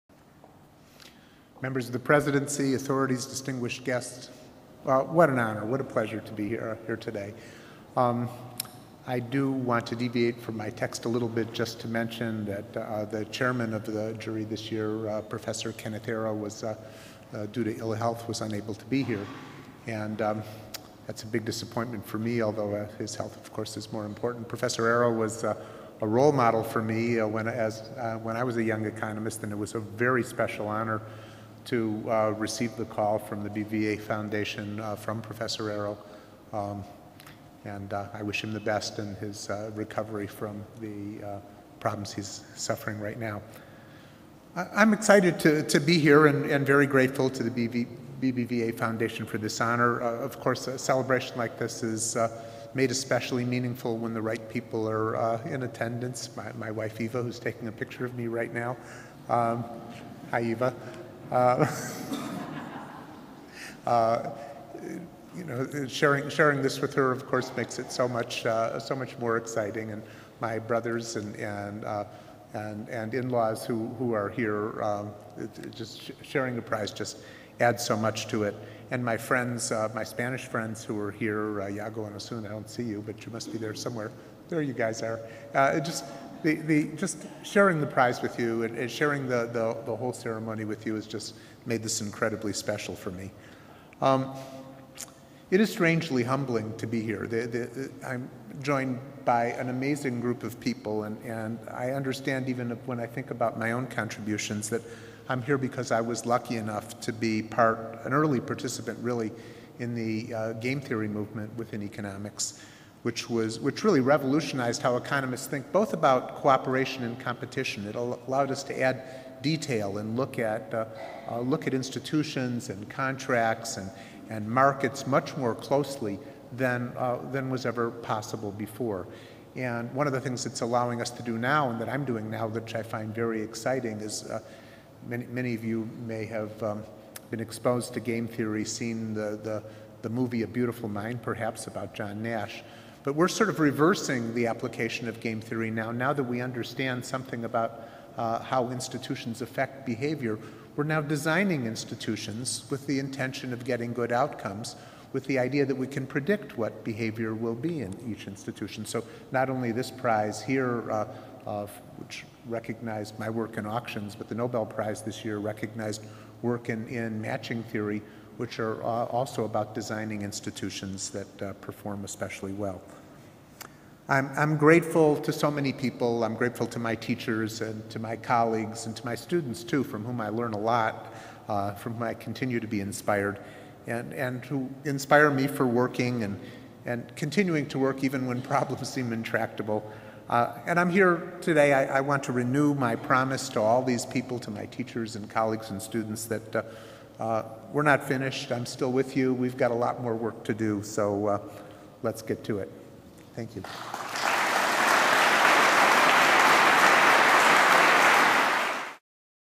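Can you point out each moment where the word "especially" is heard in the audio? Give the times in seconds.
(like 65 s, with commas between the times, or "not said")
52 s, 172 s.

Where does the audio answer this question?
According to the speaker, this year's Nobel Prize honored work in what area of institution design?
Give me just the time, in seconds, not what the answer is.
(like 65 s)
167 s.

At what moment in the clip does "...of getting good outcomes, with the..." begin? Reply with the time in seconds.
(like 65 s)
153 s.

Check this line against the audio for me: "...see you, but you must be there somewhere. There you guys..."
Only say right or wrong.
right.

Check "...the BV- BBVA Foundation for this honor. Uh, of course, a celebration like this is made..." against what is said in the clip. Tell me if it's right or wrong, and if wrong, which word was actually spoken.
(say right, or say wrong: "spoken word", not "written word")
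right.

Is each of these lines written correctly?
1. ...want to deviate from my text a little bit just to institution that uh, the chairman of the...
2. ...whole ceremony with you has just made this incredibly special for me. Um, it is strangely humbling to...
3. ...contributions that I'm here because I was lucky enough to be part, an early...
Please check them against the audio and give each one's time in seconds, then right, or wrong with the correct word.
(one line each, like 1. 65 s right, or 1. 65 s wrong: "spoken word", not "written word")
1. 9 s wrong: "mention", not "institution"
2. 89 s right
3. 103 s right.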